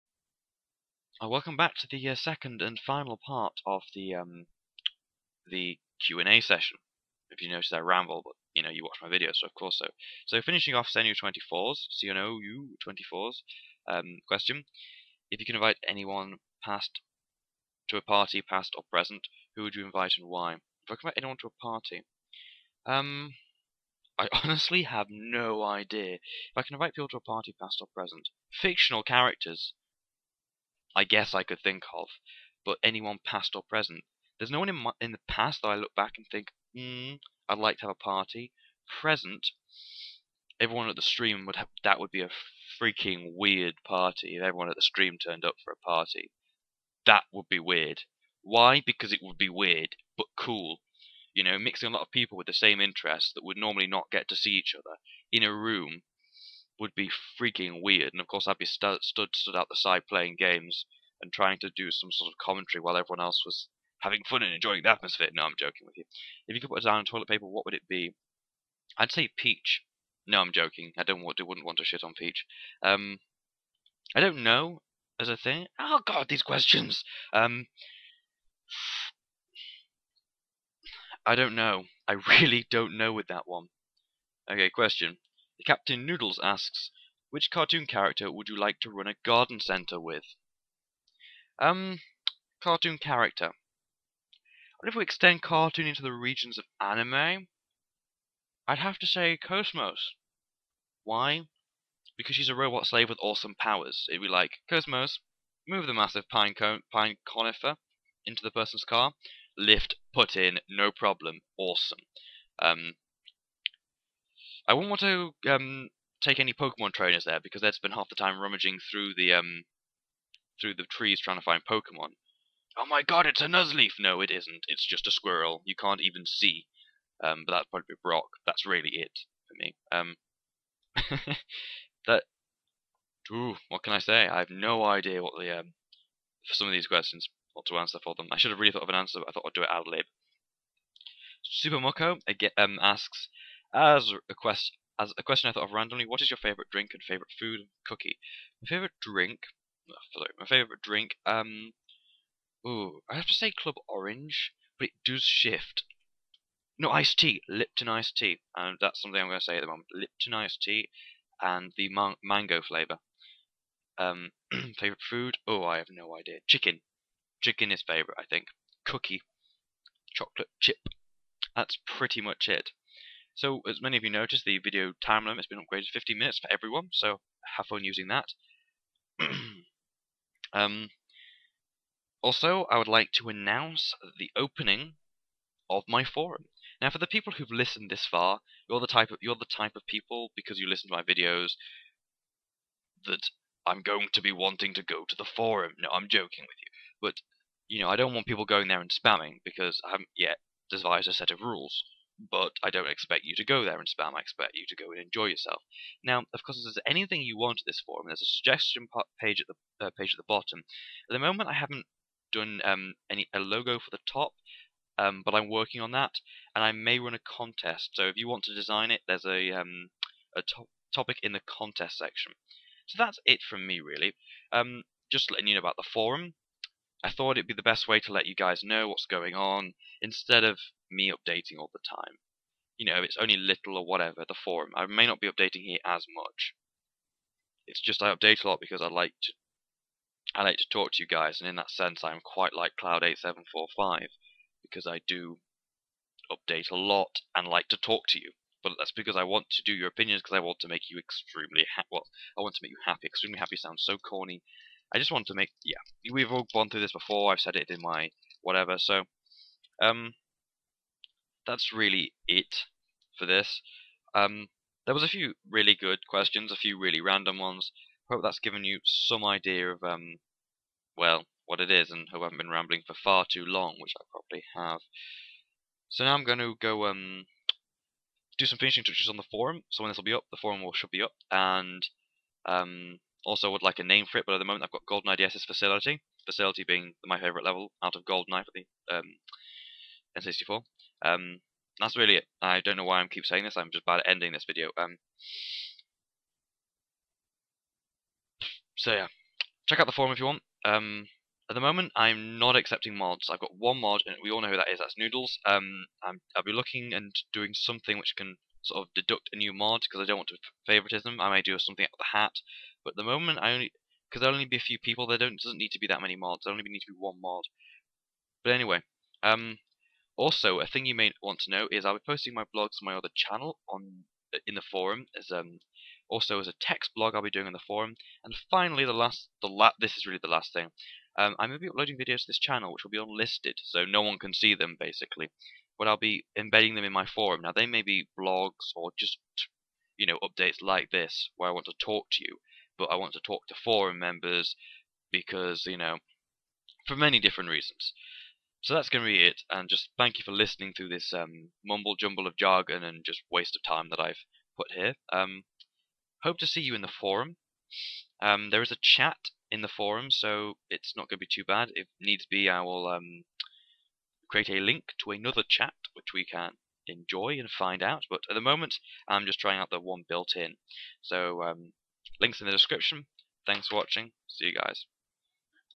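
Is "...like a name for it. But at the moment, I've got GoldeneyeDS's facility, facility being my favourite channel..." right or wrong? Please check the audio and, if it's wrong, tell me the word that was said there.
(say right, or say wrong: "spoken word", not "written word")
wrong: "level", not "channel".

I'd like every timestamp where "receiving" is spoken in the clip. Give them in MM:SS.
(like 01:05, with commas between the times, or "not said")
not said.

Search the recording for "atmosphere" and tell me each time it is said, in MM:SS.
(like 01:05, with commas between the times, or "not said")
01:04.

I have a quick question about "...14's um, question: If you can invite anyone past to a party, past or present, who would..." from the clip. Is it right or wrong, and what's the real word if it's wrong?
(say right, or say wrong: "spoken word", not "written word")
wrong: "24", not "14".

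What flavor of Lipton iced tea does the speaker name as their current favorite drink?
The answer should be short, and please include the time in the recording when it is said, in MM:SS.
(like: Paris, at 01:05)
Mango, at 02:42.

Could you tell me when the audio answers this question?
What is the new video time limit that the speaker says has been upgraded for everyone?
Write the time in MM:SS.
02:55.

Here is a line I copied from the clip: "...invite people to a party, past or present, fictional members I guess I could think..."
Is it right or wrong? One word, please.
wrong.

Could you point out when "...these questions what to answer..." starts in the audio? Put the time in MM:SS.
02:16.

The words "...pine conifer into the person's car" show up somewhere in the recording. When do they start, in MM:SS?
01:46.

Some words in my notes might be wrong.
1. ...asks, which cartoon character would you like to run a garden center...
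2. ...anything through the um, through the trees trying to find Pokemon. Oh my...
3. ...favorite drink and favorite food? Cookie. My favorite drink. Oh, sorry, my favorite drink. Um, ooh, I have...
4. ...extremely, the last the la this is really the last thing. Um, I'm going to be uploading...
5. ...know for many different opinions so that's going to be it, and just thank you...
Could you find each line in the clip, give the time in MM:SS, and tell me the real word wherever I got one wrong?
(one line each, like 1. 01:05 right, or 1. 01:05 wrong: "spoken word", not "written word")
1. 01:26 right
2. 01:58 wrong: "rummaging", not "anything"
3. 02:26 right
4. 05:28 wrong: "finally", not "extremely"
5. 05:45 wrong: "reasons", not "opinions".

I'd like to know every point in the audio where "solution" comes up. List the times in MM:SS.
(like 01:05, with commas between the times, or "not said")
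not said.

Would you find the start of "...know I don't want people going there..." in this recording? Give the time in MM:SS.
03:17.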